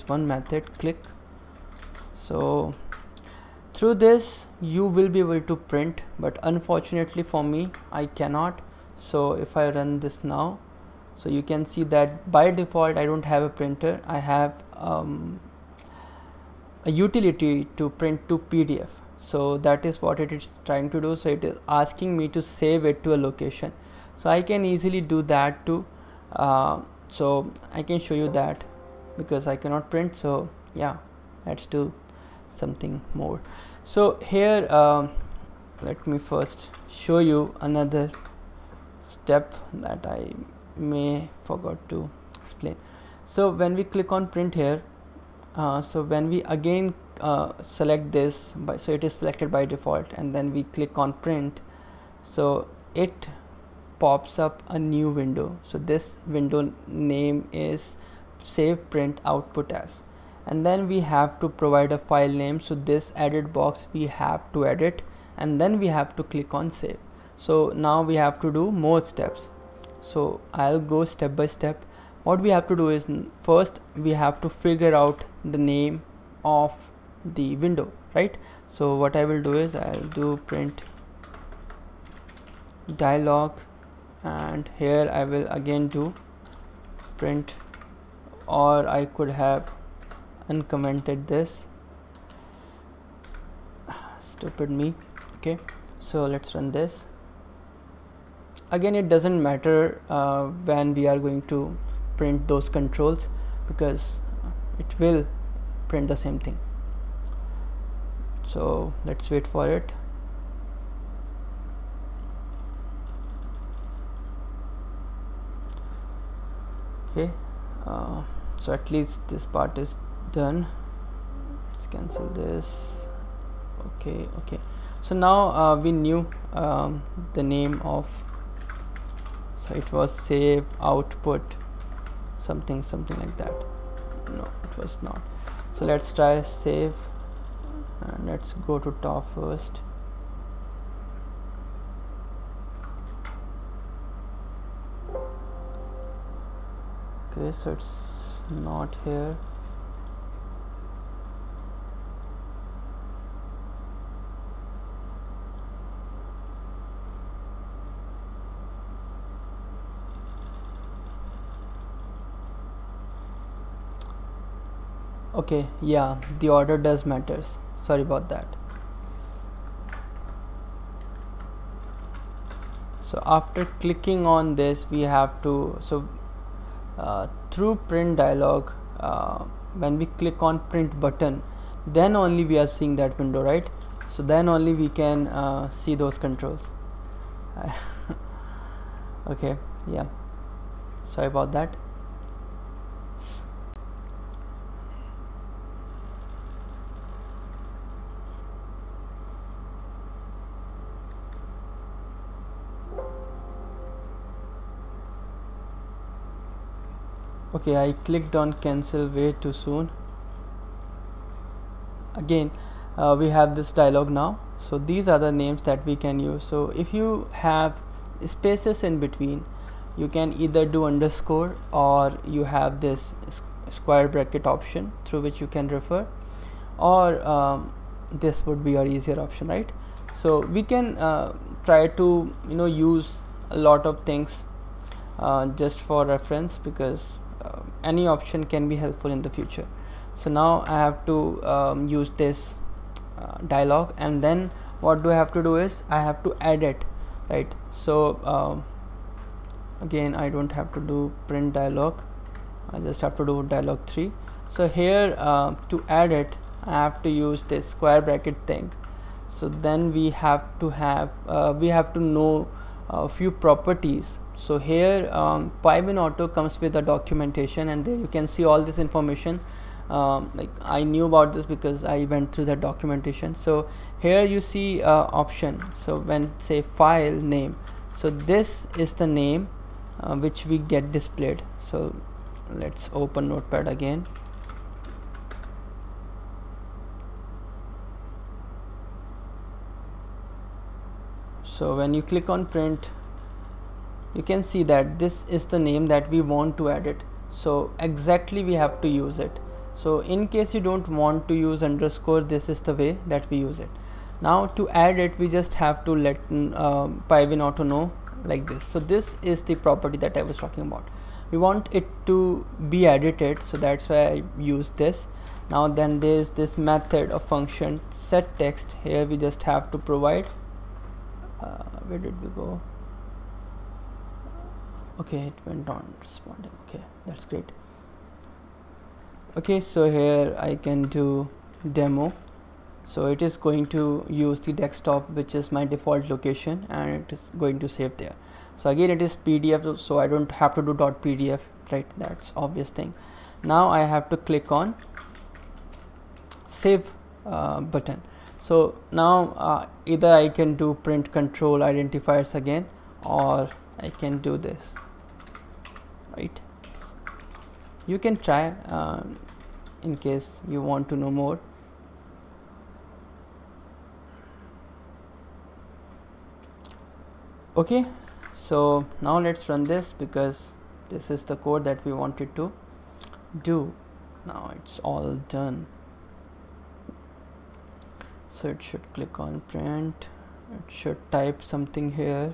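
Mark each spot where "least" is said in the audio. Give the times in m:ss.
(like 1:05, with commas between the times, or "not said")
1:58.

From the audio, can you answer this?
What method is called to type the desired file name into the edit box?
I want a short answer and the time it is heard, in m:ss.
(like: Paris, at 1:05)
set text, at 5:17.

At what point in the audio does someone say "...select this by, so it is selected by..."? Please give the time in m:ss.
0:47.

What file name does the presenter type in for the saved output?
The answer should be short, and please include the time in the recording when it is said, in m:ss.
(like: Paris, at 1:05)
demo, at 5:31.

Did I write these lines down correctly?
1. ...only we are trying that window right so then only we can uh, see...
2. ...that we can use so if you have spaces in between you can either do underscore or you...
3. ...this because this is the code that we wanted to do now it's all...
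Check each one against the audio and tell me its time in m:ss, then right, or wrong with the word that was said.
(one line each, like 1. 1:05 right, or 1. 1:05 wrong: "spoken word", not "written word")
1. 3:02 wrong: "seeing", not "trying"
2. 3:35 right
3. 6:09 right.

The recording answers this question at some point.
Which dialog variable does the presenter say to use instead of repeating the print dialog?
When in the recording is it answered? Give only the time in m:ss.
4:13.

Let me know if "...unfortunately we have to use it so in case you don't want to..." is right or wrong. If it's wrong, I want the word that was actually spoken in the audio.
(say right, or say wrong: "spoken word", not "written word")
wrong: "exactly", not "unfortunately".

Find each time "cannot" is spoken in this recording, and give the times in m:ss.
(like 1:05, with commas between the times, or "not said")
0:08, 0:29.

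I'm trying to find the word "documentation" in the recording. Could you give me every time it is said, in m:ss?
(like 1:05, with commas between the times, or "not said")
4:26, 4:32.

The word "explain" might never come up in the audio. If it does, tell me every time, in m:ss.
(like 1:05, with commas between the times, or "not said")
0:42.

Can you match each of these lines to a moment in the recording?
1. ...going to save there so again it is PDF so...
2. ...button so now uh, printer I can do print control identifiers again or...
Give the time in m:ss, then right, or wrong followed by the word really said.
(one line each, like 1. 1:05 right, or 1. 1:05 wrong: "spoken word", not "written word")
1. 5:37 right
2. 5:47 wrong: "either", not "printer".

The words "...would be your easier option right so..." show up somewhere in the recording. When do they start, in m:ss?
3:48.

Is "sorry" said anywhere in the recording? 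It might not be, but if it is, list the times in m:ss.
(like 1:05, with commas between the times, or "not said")
2:47, 3:11.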